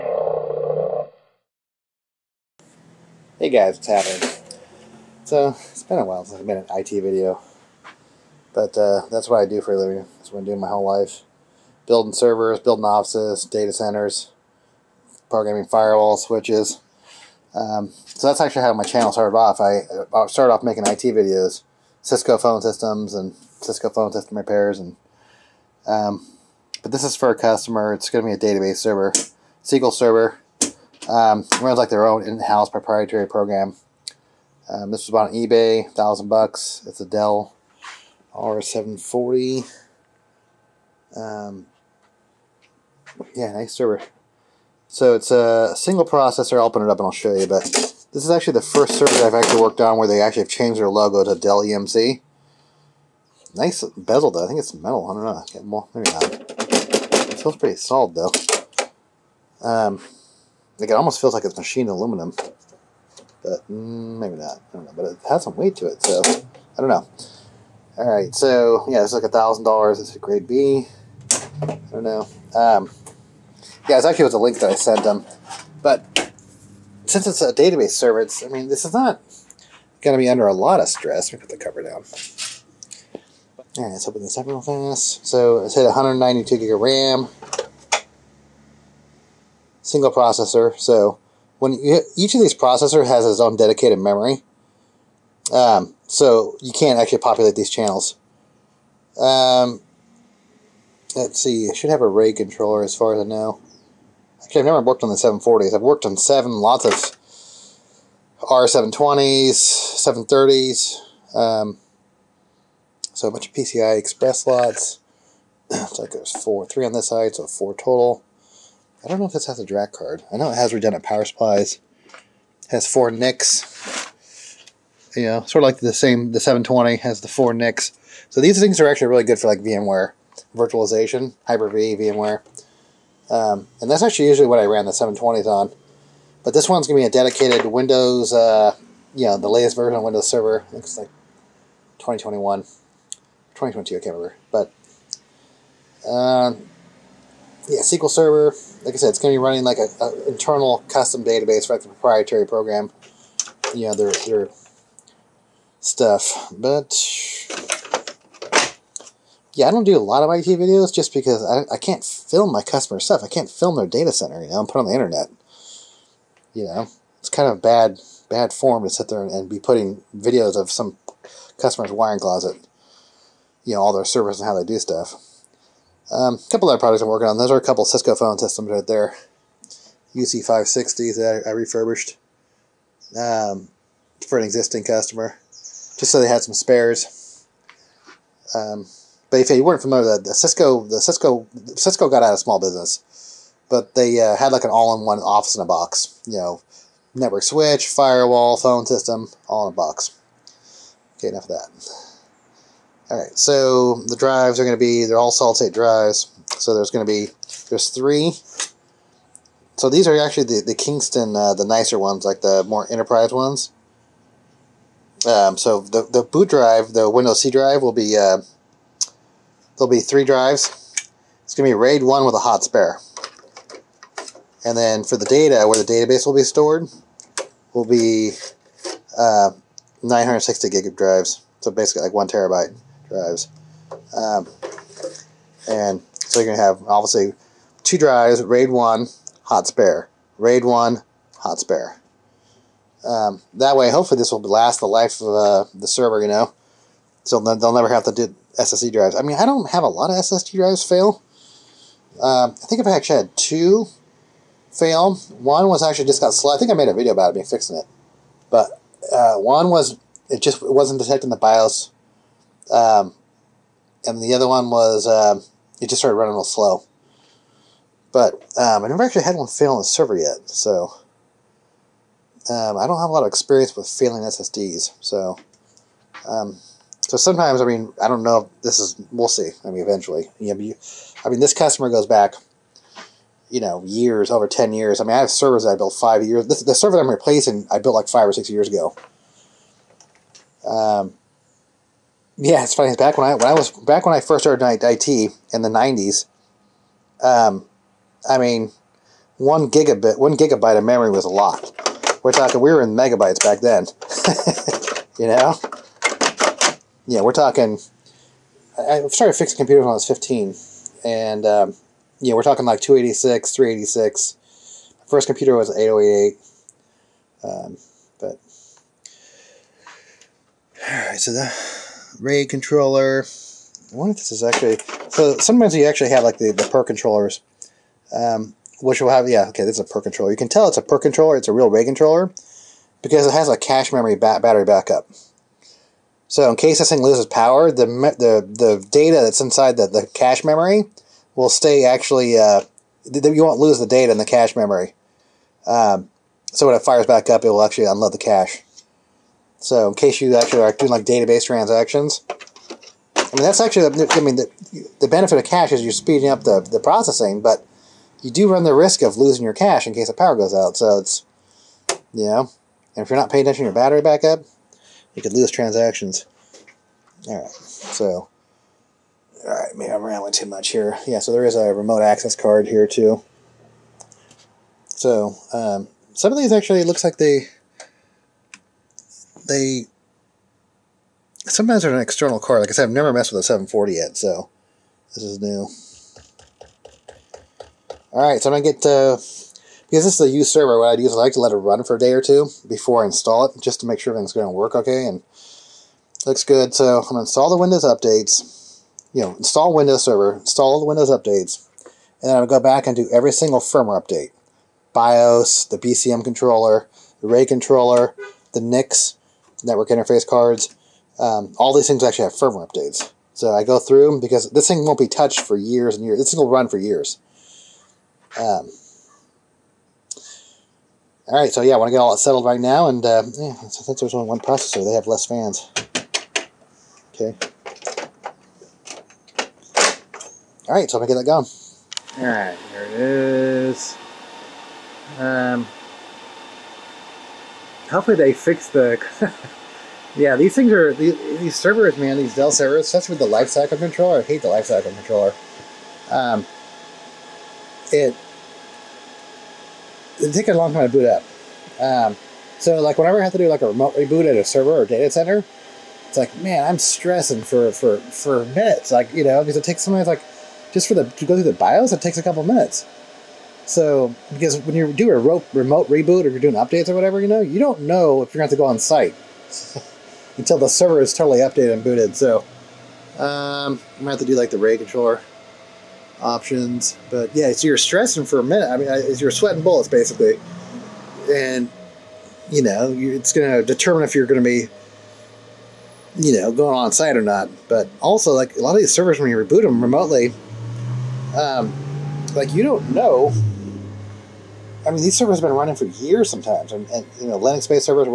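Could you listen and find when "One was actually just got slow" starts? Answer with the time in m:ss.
4:15.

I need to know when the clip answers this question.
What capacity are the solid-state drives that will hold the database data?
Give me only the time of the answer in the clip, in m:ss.
3:50.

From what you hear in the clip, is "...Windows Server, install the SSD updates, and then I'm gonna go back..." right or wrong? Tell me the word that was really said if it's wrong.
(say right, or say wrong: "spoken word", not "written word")
wrong: "Windows", not "SSD".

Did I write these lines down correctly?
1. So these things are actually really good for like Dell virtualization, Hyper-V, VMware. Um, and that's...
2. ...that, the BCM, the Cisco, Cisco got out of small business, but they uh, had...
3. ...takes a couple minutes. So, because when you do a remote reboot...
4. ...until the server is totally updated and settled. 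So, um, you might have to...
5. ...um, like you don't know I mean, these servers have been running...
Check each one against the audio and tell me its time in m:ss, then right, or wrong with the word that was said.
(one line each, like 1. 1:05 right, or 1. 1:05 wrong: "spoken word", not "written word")
1. 2:08 wrong: "VMware", not "Dell"
2. 3:10 wrong: "Cisco", not "BCM"
3. 7:42 right
4. 7:50 wrong: "booted", not "settled"
5. 8:11 right.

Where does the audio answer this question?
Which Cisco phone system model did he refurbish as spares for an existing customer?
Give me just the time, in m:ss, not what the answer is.
3:00.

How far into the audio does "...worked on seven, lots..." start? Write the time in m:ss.
1:45.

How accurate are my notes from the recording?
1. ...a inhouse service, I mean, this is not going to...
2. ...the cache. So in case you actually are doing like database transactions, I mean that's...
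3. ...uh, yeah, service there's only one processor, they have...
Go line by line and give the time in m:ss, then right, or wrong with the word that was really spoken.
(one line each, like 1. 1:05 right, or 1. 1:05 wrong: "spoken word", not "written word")
1. 1:17 wrong: "database", not "inhouse"
2. 5:48 right
3. 7:03 wrong: "since", not "service".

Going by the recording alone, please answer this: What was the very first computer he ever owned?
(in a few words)
8088.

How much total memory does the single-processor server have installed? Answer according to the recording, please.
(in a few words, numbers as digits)
192 gig.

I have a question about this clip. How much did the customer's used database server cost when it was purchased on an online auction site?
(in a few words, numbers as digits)
thousand bucks.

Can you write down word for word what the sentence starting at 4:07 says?
So they'll never have to do SSD drives.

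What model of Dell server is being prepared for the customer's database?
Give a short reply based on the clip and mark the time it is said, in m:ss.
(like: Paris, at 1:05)
R740, at 0:38.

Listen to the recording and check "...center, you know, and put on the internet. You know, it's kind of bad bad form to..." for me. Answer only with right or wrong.
right.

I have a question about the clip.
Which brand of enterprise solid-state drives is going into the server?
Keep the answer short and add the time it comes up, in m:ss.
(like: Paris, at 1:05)
Kingston, at 3:30.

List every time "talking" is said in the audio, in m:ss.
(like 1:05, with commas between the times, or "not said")
5:02, 5:07, 5:12.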